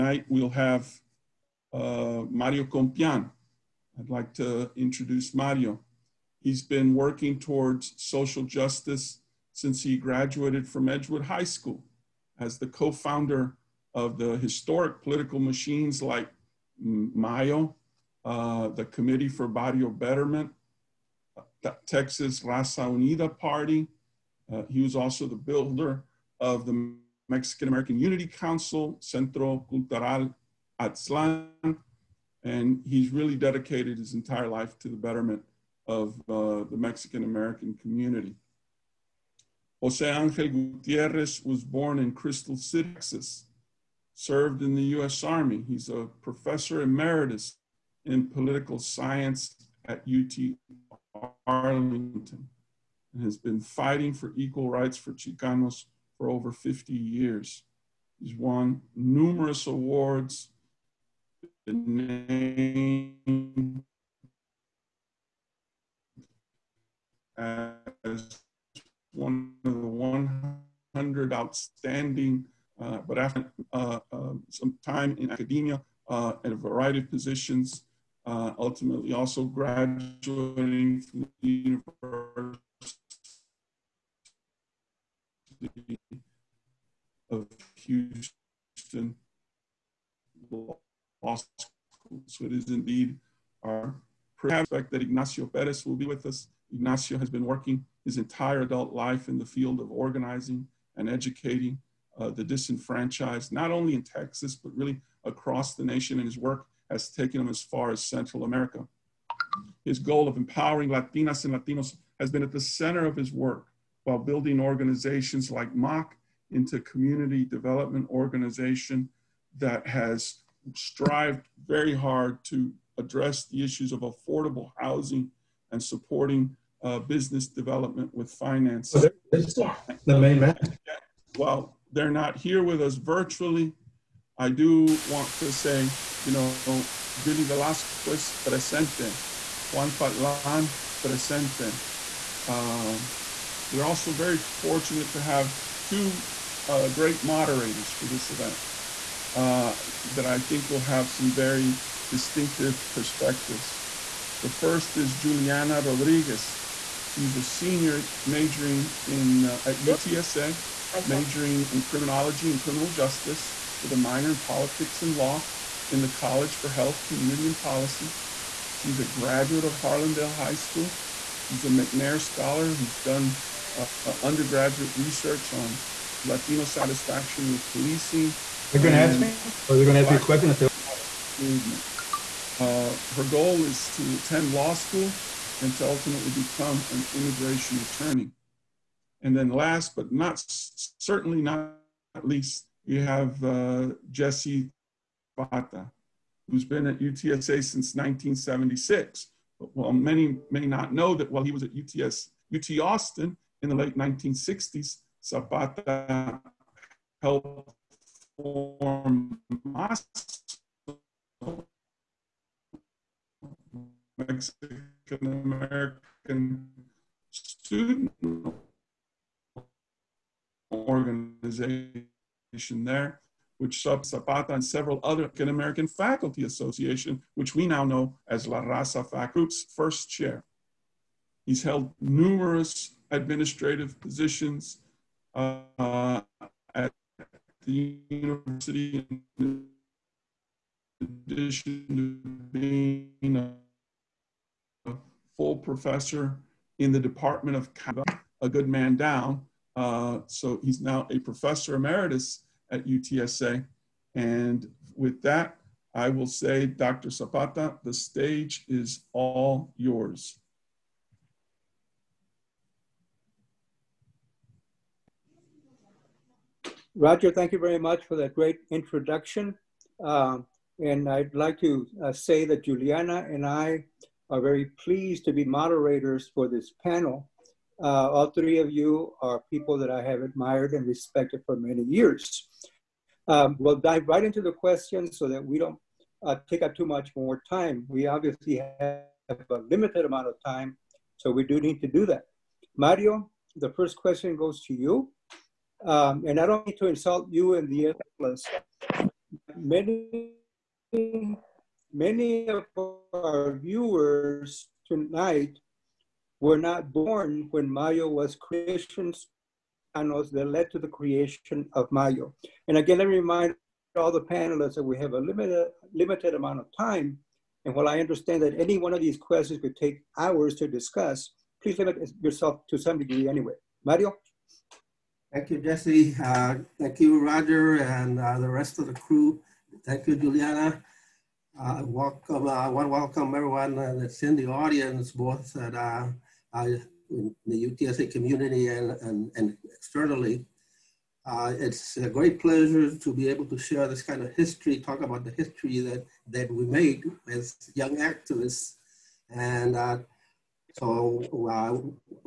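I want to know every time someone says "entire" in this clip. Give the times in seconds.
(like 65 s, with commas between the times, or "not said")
34 s, 98 s.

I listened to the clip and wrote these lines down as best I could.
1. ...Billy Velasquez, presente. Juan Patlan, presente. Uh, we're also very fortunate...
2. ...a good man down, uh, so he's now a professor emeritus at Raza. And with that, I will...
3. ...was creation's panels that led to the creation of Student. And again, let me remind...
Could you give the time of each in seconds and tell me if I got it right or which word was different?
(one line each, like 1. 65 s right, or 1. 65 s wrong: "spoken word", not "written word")
1. 137 s right
2. 248 s wrong: "UTSA", not "Raza"
3. 308 s wrong: "Mayo", not "Student".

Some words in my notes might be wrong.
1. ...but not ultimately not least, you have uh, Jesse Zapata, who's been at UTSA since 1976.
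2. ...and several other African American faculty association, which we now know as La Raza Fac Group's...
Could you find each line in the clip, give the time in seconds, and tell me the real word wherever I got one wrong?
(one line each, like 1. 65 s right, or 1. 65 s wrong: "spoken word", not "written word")
1. 189 s wrong: "certainly", not "ultimately"
2. 224 s right.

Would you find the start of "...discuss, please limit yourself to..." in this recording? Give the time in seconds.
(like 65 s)
320 s.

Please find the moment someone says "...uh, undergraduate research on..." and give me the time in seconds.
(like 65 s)
173 s.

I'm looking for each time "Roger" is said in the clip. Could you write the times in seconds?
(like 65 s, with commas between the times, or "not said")
266 s, 327 s.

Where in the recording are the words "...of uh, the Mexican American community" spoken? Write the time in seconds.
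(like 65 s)
35 s.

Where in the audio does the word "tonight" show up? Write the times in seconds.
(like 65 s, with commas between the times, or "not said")
304 s.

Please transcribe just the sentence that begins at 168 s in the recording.
She's a graduate of Harlandale High School.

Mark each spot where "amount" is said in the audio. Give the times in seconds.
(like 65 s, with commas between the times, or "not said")
290 s, 316 s.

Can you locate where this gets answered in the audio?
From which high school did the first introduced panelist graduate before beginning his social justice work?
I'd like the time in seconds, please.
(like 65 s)
10 s.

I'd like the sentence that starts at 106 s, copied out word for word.
And his work has taken him as far as Central America.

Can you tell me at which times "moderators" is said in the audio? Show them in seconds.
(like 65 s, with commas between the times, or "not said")
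147 s, 275 s.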